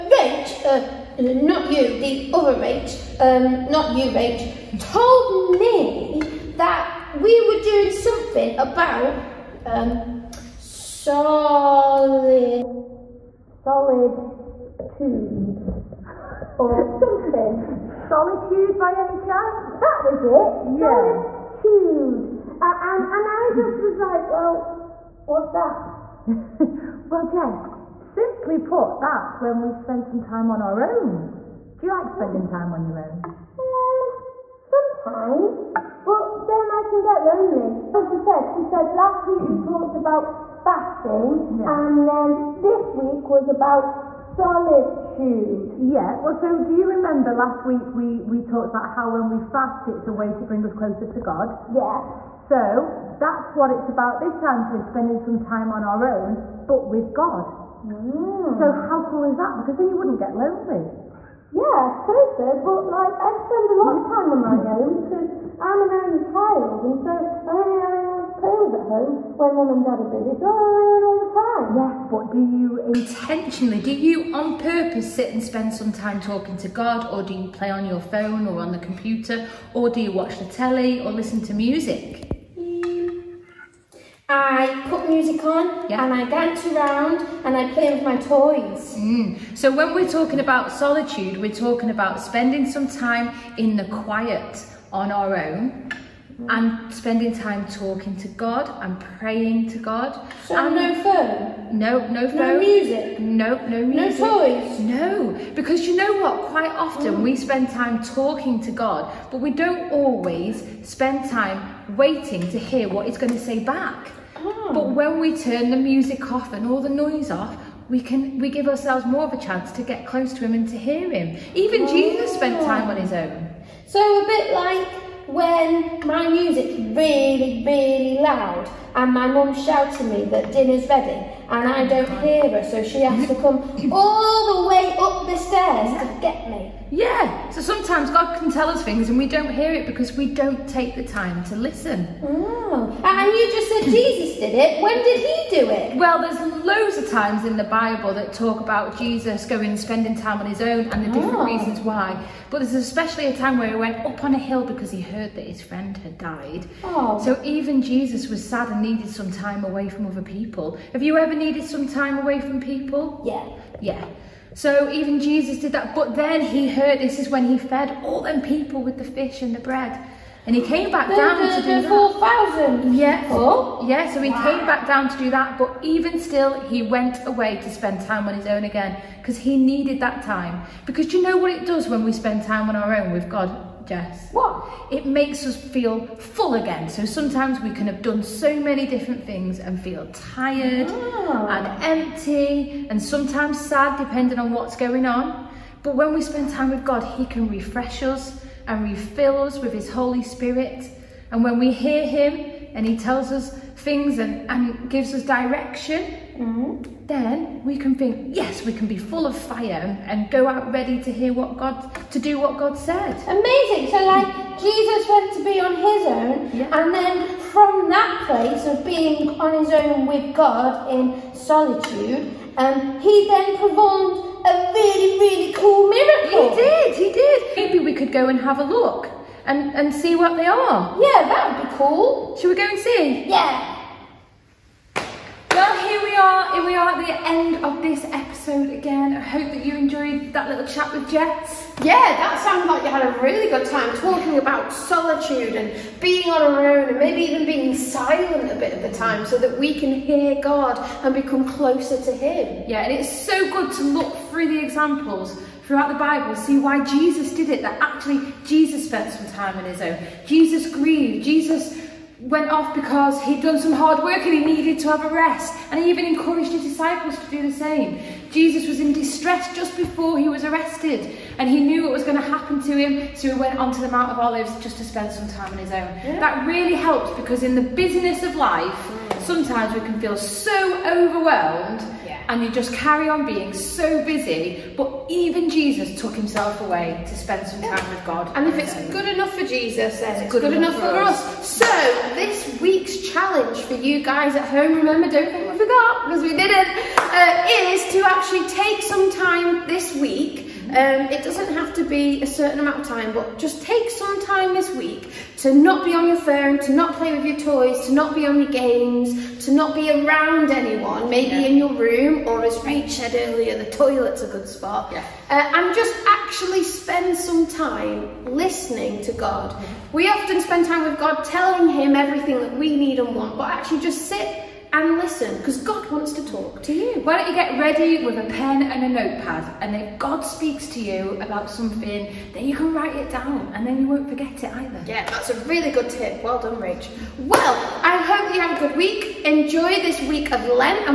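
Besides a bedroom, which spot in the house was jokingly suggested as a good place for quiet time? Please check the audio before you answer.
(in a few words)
The toilet.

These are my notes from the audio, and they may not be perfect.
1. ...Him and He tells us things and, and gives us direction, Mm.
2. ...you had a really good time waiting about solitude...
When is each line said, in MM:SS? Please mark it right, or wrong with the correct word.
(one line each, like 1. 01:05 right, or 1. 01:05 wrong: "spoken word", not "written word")
1. 03:22 right
2. 04:02 wrong: "talking", not "waiting".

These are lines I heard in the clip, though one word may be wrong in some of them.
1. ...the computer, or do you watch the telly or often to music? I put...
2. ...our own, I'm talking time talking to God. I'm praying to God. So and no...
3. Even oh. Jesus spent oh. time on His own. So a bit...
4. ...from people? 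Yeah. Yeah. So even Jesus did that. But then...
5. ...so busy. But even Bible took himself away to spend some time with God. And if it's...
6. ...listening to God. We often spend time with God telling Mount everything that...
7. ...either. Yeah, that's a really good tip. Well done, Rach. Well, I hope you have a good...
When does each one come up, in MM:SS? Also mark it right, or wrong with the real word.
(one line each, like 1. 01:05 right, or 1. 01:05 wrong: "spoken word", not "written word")
1. 01:18 wrong: "listen", not "often"
2. 01:35 wrong: "spending", not "talking"
3. 02:01 right
4. 02:42 right
5. 04:43 wrong: "Jesus", not "Bible"
6. 05:18 wrong: "Him", not "Mount"
7. 05:34 right.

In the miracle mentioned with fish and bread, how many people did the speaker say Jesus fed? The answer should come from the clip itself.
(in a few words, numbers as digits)
4,000.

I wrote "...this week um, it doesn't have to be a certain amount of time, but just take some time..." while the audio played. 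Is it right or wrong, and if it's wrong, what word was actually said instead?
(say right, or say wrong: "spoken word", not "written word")
right.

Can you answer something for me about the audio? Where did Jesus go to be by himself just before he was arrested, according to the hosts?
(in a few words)
Mount of Olives.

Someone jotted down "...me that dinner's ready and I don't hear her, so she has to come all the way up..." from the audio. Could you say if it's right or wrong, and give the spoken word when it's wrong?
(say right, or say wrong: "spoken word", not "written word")
right.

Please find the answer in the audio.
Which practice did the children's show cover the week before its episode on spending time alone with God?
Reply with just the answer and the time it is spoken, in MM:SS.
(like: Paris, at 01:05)
Fasting, at 00:40.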